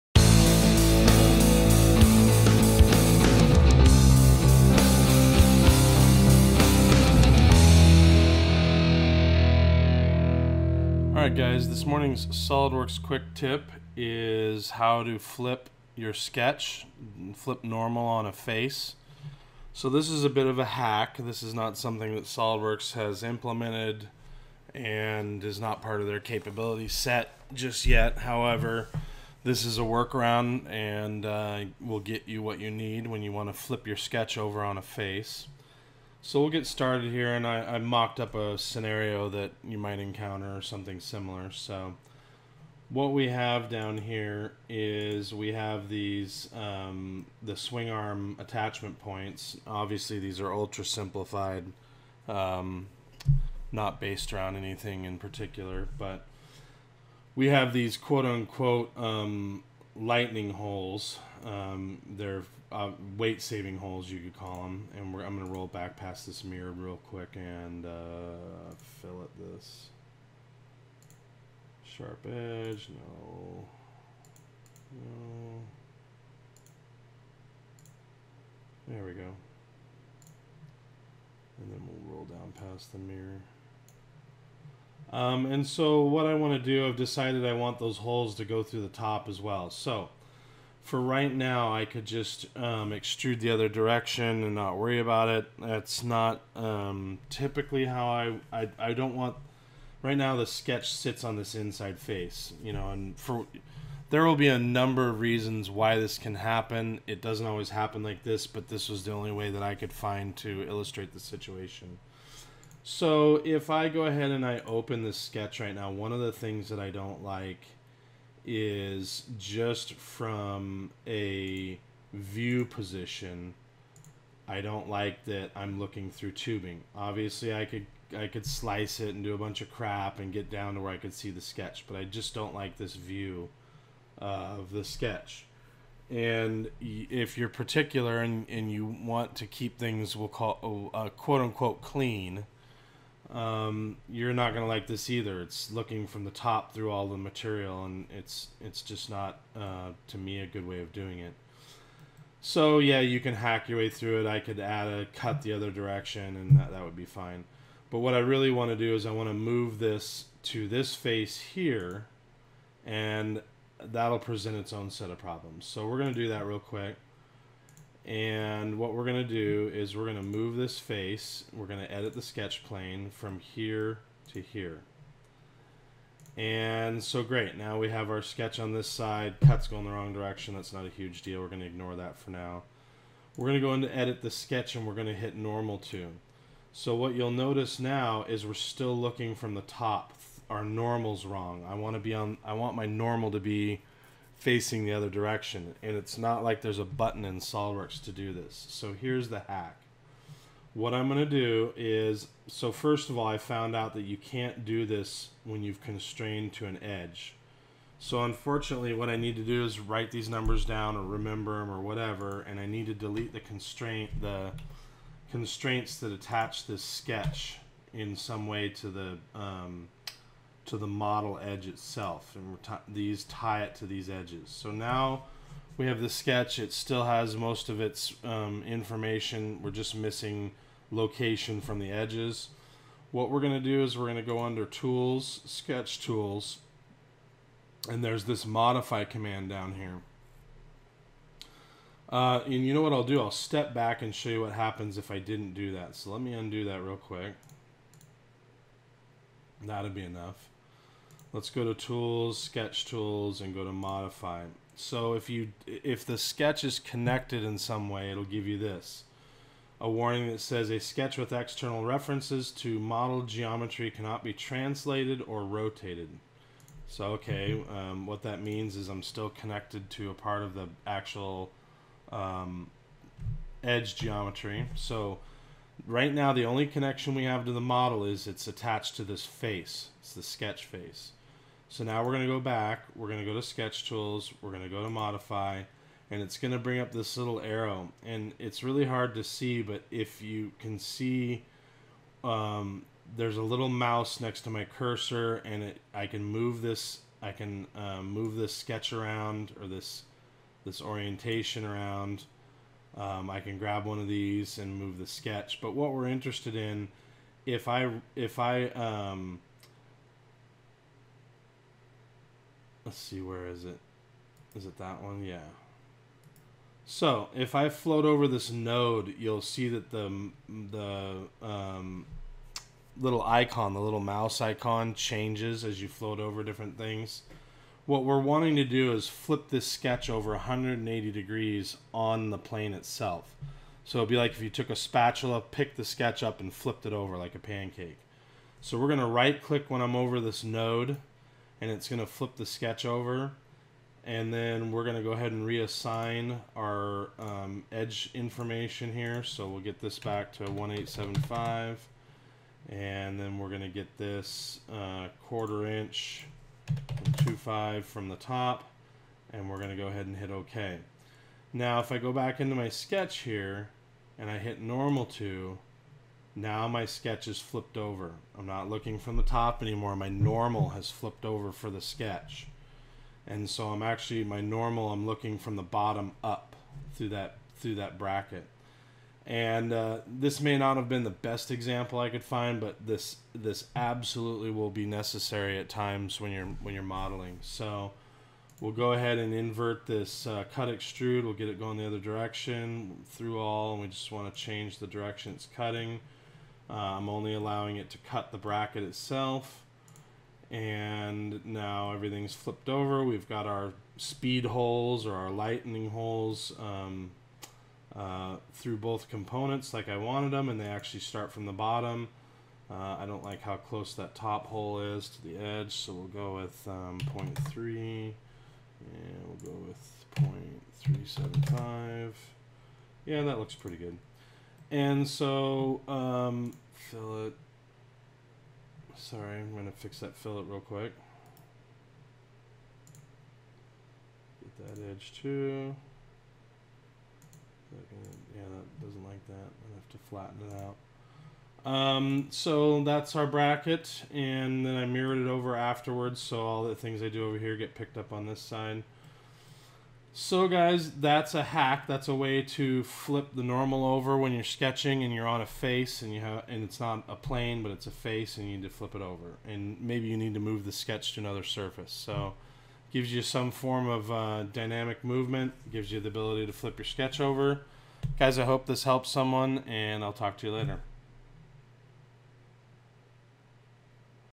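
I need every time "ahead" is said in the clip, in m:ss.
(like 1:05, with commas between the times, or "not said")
1:54, 5:45, 5:59, 6:28.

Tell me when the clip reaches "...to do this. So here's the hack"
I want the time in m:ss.
3:18.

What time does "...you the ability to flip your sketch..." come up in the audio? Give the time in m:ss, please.
7:45.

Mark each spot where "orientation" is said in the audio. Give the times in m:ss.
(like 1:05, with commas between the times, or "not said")
5:00.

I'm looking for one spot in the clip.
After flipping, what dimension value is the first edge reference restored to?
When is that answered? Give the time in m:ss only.
5:50.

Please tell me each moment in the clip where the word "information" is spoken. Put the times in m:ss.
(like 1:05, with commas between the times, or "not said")
3:48, 5:48.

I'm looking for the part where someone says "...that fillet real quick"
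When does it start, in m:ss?
7:09.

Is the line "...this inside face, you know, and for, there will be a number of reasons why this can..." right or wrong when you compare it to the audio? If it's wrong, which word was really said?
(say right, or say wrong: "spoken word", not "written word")
right.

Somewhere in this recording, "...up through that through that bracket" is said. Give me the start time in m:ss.
6:16.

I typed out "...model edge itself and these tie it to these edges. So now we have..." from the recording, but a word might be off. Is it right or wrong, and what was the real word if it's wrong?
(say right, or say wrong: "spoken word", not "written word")
right.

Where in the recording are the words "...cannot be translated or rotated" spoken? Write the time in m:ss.
4:23.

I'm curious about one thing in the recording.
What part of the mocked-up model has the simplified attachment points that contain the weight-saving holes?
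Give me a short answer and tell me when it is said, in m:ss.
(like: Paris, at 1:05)
swing arm, at 0:47.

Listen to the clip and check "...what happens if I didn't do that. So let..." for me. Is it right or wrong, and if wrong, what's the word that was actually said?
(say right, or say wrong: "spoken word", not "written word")
right.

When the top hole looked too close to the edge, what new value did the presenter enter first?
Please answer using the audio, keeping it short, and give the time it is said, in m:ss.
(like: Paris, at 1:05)
0.3, at 6:57.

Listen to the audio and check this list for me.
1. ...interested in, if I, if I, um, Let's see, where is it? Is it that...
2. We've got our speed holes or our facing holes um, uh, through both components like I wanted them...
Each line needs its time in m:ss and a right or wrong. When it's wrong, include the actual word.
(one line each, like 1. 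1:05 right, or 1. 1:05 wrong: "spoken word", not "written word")
1. 5:06 right
2. 6:43 wrong: "lightning", not "facing".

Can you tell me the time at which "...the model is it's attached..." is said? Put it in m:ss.
4:37.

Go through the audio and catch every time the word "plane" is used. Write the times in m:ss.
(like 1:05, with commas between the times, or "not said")
2:52, 5:32, 7:37.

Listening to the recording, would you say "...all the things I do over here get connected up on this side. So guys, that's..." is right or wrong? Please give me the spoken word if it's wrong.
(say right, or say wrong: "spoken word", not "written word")
wrong: "picked", not "connected".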